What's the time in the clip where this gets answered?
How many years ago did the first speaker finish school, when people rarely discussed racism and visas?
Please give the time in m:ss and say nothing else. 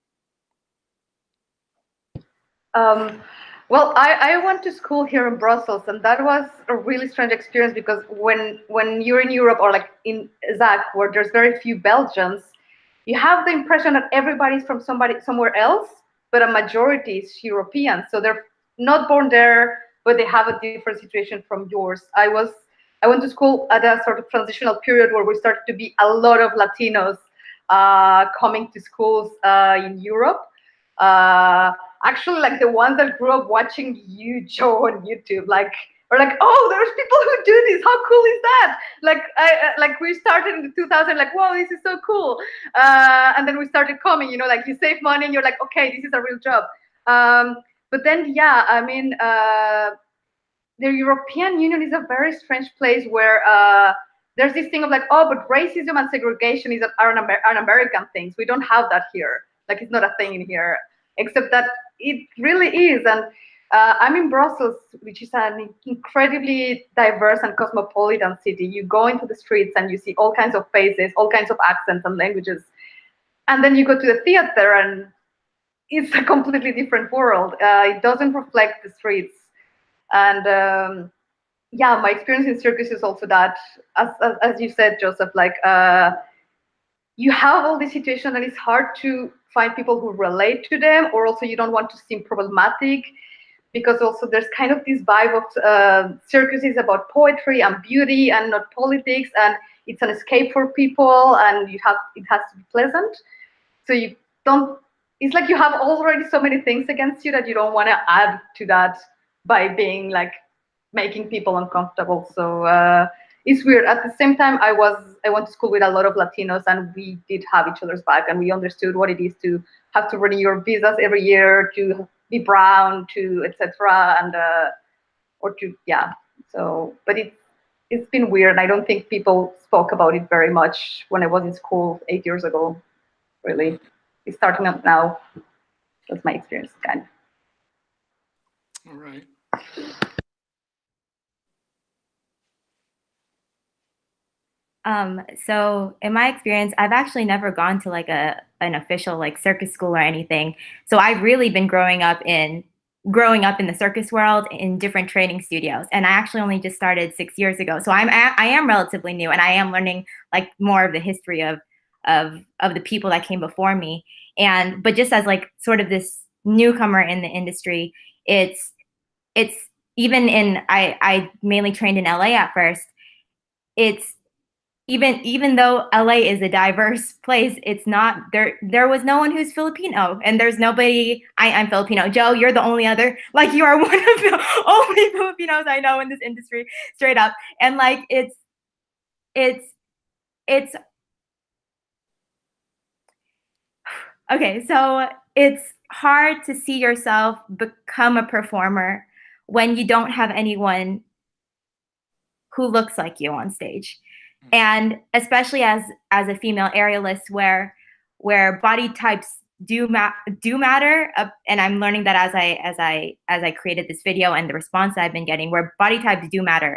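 2:12.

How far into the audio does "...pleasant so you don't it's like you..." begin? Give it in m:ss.
1:42.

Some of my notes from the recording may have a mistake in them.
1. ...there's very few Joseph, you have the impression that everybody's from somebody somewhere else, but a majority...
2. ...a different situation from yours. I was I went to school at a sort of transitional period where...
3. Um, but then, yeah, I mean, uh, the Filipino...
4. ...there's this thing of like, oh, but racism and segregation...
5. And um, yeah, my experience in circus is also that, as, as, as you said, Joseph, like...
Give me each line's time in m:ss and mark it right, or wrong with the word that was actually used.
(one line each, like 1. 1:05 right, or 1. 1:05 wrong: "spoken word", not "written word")
1. 0:11 wrong: "Belgians", not "Joseph"
2. 0:20 right
3. 0:47 wrong: "European", not "Filipino"
4. 0:54 right
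5. 1:20 right.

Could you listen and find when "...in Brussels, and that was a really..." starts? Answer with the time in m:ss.
0:05.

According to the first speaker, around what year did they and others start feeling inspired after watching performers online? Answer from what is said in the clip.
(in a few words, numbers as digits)
2000.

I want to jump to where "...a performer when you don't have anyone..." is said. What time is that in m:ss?
3:18.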